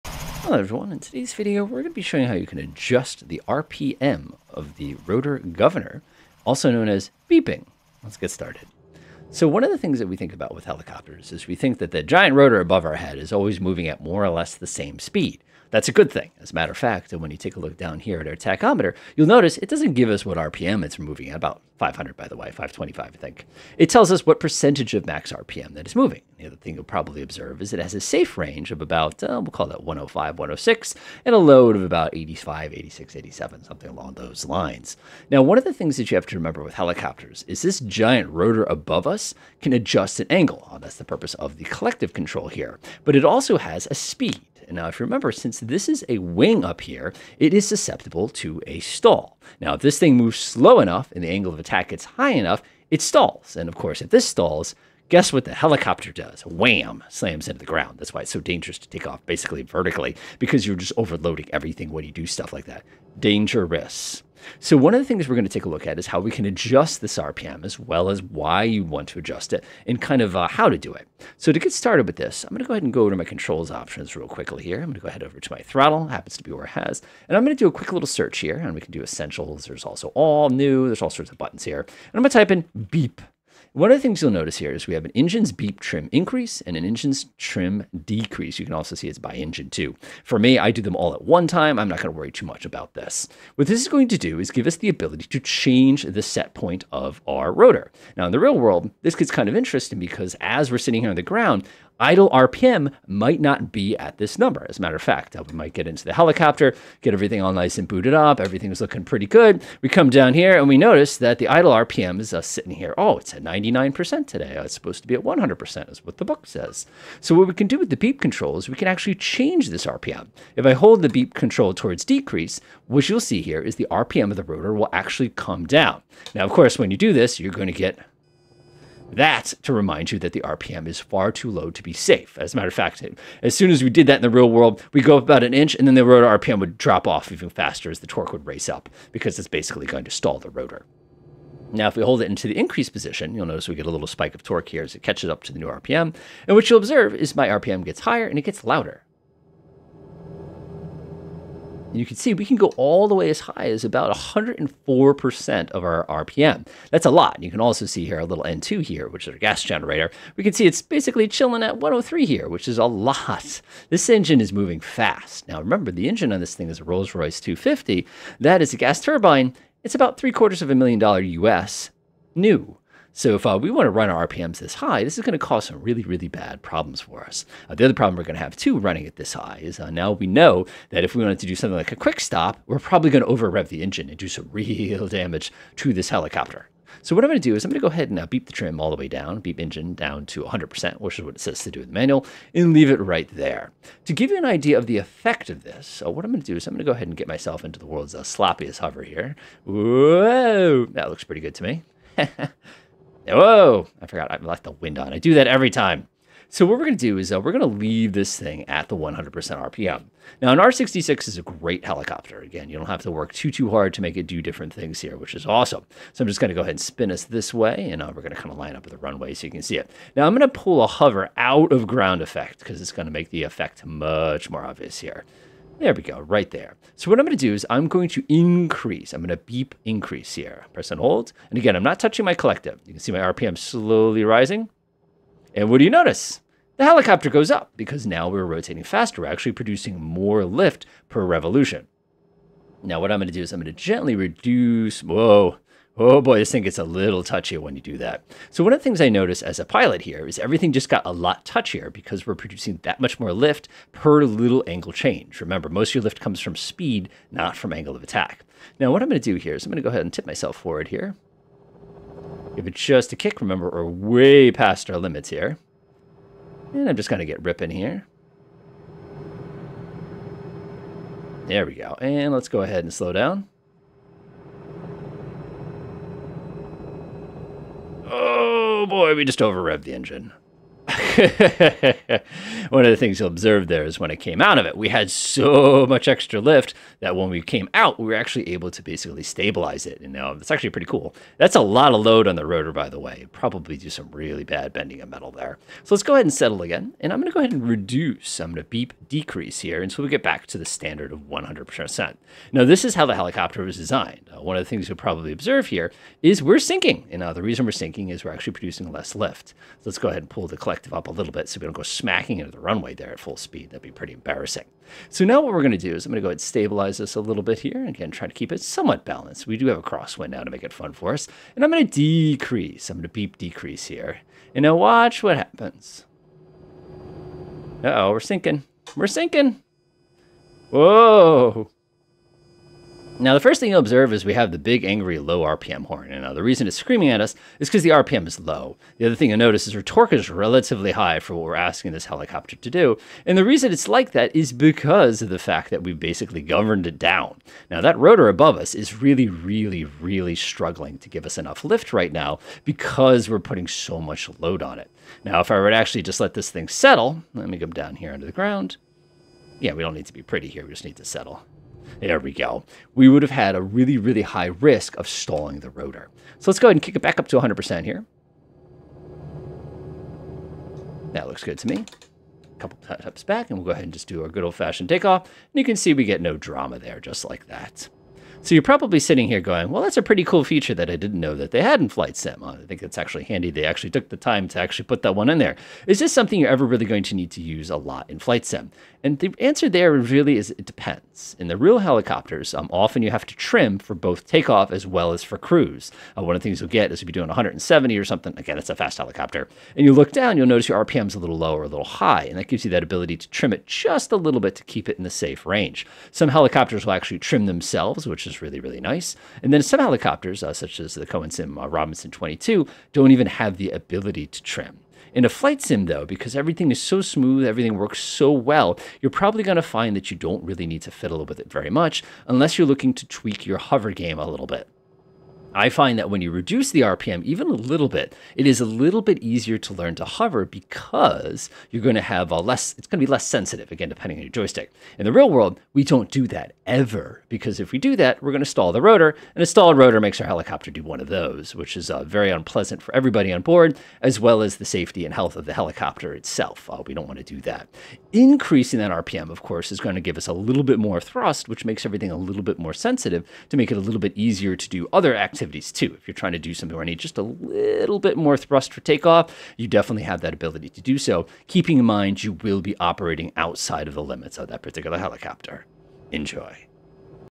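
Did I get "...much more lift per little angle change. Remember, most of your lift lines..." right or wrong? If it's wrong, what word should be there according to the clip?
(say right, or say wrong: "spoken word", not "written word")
wrong: "comes", not "lines".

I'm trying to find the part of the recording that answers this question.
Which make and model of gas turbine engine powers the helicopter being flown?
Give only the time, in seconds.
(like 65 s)
166 s.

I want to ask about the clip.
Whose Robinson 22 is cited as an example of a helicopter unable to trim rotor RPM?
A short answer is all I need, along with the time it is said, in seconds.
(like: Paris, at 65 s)
Cowan Sim, at 411 s.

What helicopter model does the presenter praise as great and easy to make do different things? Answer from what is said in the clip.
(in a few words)
R66.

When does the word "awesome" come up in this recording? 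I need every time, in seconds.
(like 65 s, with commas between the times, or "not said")
215 s.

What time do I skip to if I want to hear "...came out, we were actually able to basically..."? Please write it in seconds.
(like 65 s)
287 s.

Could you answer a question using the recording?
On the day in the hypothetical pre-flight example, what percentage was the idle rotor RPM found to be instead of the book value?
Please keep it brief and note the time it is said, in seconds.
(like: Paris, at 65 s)
99%, at 113 s.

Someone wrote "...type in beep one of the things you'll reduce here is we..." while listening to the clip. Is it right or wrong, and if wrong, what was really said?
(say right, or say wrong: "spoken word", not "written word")
wrong: "notice", not "reduce".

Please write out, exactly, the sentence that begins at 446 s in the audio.
Uh, we don't want to do that.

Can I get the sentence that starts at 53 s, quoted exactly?
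And of course, if this stalls, Guess what the helicopter does?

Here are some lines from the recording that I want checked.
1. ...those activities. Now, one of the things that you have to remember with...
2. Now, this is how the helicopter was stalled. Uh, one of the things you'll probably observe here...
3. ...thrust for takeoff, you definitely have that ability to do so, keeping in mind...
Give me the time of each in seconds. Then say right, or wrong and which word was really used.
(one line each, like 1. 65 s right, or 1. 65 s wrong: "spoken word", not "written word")
1. 34 s wrong: "lines", not "activities"
2. 302 s wrong: "designed", not "stalled"
3. 458 s right.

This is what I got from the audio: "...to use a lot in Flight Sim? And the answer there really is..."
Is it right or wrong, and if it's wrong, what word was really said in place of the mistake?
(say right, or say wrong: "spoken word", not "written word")
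right.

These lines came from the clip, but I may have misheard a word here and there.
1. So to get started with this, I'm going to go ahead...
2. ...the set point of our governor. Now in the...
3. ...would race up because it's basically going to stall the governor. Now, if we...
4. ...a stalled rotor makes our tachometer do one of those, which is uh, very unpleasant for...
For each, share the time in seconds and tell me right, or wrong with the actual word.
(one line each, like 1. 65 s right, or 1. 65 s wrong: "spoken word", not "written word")
1. 71 s right
2. 96 s wrong: "rotor", not "governor"
3. 138 s wrong: "rotor", not "governor"
4. 439 s wrong: "helicopter", not "tachometer".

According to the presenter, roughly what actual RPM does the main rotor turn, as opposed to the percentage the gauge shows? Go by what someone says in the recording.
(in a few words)
525.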